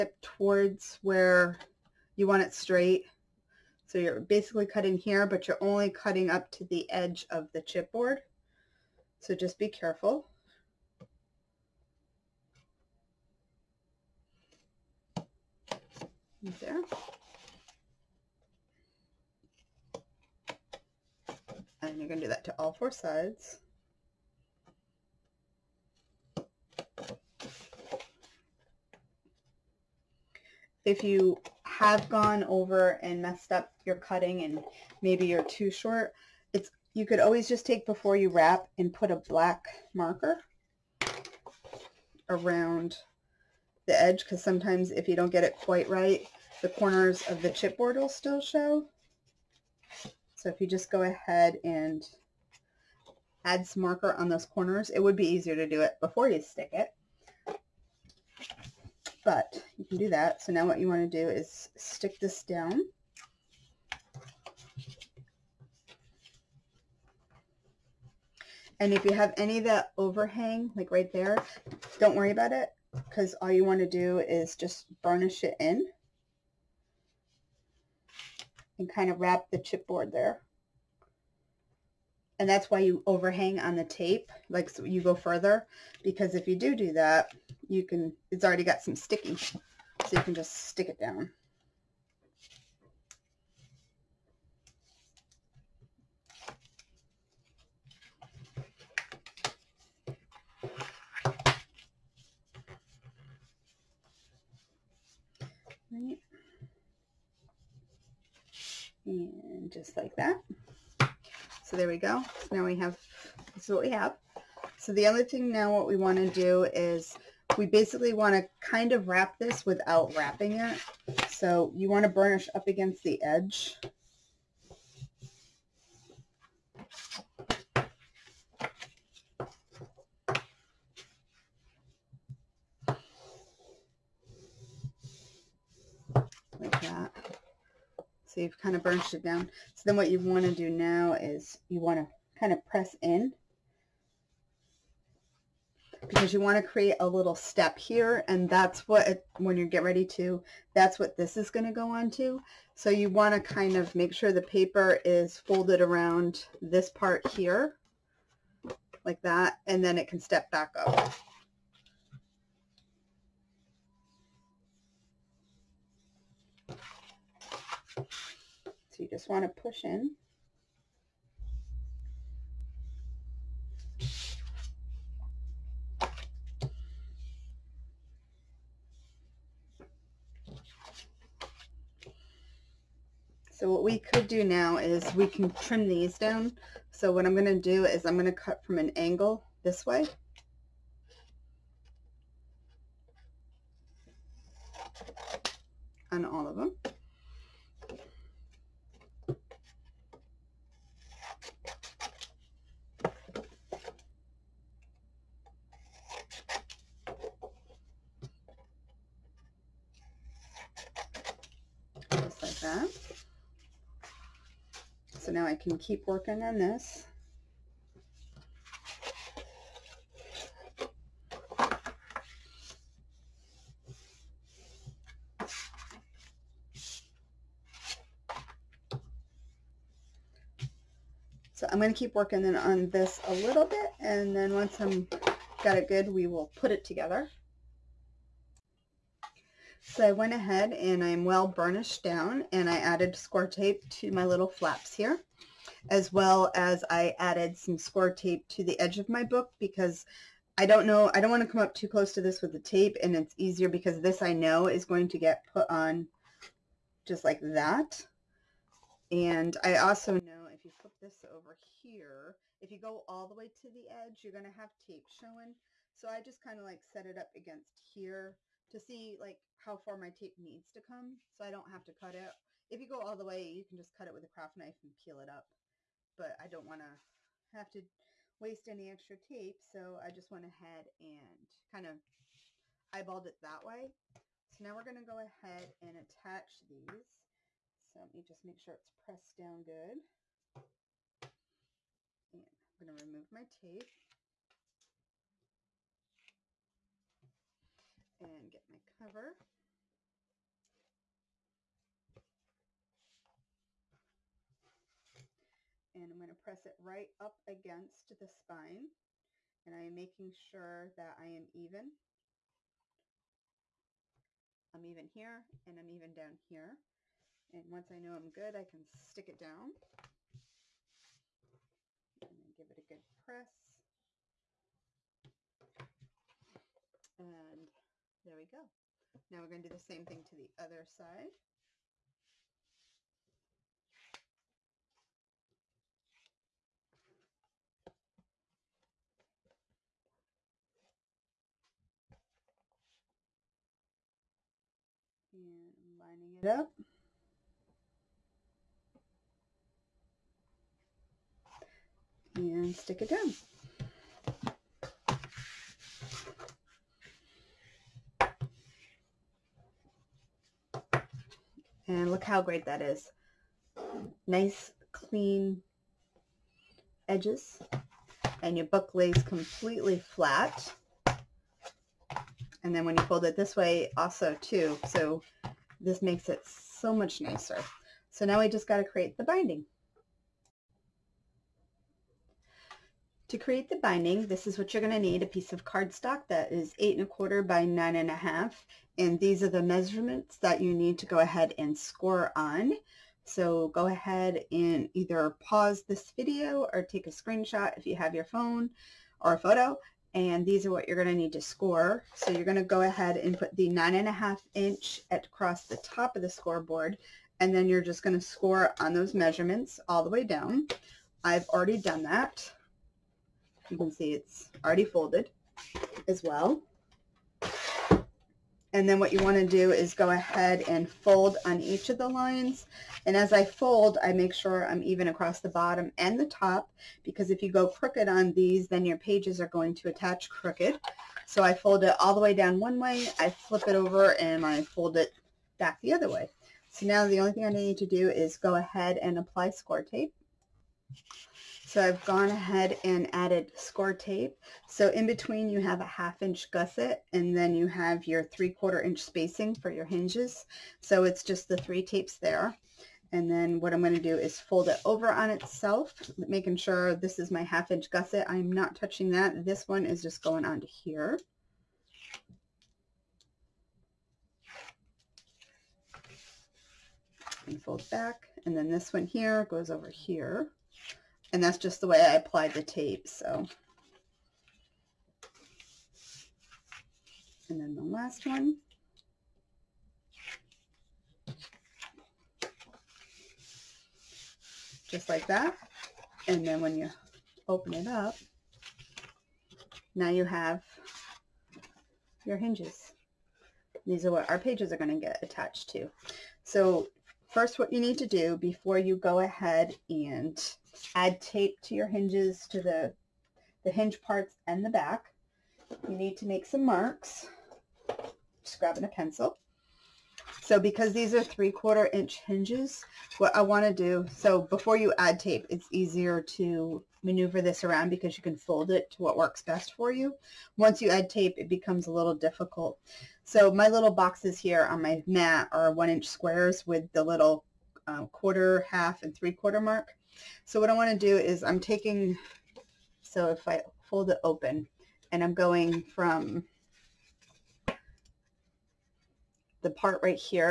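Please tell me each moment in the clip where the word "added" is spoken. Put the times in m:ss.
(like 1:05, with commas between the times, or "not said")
4:02, 4:07, 7:23.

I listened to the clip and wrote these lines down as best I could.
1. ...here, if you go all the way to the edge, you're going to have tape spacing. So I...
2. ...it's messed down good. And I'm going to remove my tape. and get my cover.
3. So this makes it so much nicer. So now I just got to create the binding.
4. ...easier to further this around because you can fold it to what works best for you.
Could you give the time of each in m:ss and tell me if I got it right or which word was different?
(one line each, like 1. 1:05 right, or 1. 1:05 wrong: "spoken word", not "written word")
1. 4:21 wrong: "showing", not "spacing"
2. 4:48 wrong: "pressed", not "messed"
3. 6:14 right
4. 8:35 wrong: "maneuver", not "further".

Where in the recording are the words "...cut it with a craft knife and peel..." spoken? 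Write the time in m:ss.
4:33.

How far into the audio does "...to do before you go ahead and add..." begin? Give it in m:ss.
8:17.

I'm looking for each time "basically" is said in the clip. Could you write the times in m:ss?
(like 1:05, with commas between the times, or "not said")
0:04, 1:57.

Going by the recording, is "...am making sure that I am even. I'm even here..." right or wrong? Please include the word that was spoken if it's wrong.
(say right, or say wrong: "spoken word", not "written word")
right.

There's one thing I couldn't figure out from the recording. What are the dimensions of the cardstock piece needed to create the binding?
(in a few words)
8 1/4 by 9 1/2.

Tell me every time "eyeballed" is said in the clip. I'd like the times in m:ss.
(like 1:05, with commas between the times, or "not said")
4:42.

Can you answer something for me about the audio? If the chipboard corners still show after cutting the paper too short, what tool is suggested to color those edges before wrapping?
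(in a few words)
black marker.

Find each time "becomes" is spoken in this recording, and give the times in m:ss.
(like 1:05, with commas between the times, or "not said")
8:41.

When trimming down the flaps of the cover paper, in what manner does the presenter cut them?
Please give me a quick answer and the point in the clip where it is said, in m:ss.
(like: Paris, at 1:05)
from an angle, at 3:08.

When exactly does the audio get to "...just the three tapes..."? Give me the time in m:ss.
7:31.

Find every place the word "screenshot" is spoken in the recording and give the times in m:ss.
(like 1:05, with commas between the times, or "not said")
6:37.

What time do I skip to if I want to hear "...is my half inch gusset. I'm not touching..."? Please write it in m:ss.
7:37.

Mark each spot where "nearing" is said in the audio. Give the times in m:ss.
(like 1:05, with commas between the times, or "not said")
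not said.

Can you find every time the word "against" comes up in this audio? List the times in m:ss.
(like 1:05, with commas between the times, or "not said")
2:02, 4:27, 5:07.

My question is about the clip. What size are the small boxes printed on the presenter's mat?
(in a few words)
1 inch squares.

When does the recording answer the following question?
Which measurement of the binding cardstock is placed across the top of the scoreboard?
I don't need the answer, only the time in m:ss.
6:43.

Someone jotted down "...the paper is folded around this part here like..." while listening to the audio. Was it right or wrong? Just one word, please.
right.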